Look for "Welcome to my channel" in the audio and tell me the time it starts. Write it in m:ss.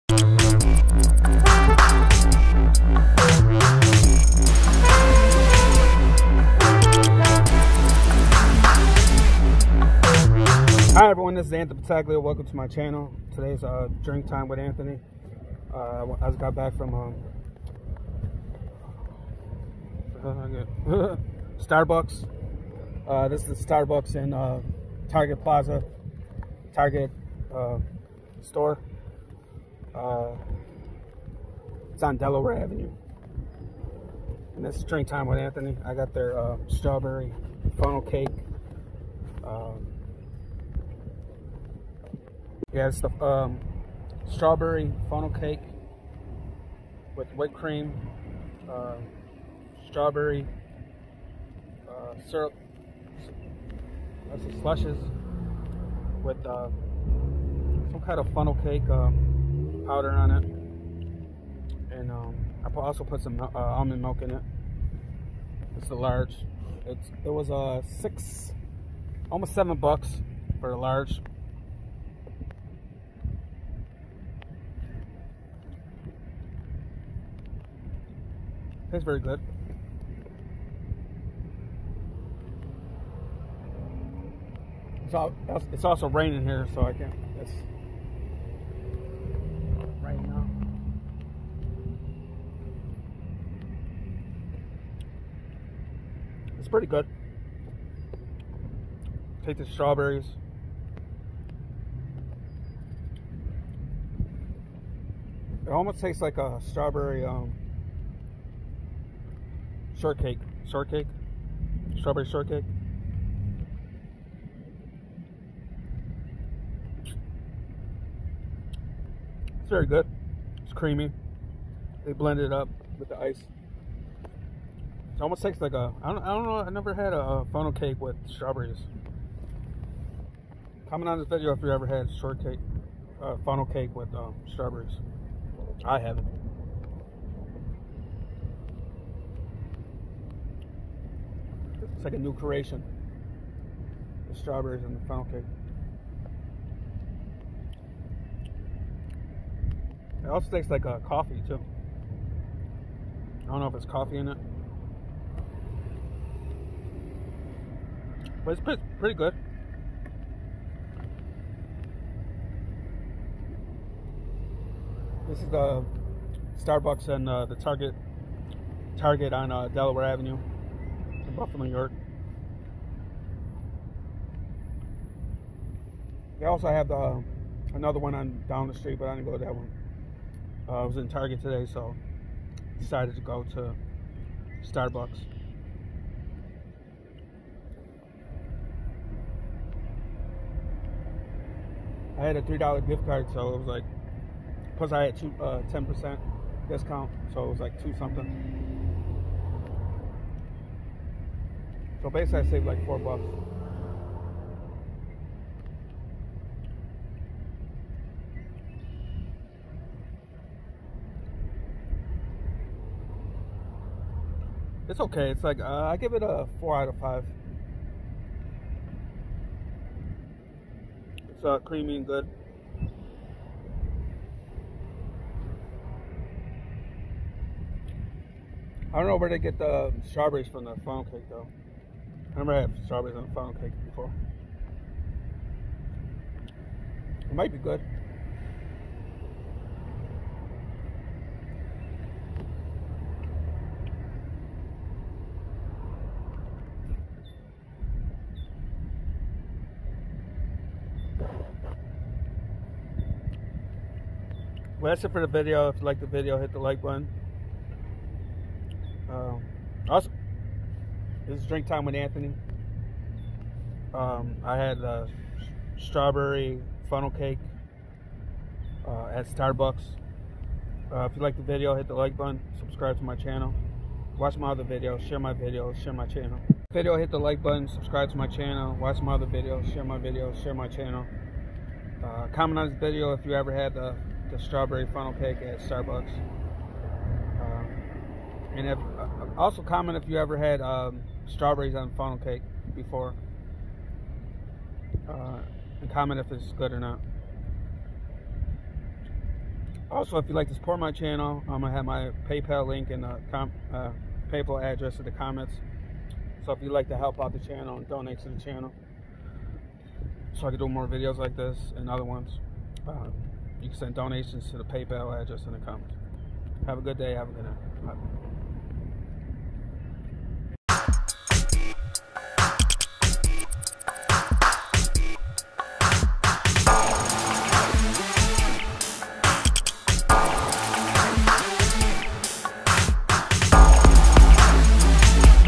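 0:12.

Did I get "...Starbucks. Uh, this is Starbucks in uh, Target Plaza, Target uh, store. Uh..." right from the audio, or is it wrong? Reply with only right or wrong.
right.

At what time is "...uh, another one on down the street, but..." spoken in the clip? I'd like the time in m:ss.
2:56.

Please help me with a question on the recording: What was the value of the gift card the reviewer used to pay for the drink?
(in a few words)
$3.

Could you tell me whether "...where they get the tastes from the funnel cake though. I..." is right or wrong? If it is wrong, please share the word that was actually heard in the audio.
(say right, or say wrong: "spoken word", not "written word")
wrong: "strawberries", not "tastes".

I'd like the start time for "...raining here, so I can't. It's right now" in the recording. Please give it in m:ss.
1:26.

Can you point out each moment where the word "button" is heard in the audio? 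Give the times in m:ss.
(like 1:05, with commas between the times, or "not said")
4:16, 4:32, 4:37.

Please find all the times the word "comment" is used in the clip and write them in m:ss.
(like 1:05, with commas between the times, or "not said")
2:10, 4:42, 4:49, 4:55, 5:05, 5:15.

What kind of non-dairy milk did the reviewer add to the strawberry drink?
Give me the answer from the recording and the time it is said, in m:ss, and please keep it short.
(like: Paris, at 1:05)
almond milk, at 1:03.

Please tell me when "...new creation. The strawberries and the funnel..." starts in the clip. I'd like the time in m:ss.
2:22.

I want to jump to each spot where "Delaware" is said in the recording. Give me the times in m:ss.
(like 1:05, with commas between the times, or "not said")
0:32, 2:49.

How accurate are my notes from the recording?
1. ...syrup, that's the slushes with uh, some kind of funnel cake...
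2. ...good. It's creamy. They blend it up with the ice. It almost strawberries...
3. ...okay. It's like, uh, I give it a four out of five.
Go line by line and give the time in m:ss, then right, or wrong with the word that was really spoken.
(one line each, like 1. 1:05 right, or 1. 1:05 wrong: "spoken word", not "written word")
1. 0:52 right
2. 1:59 wrong: "tastes", not "strawberries"
3. 3:34 right.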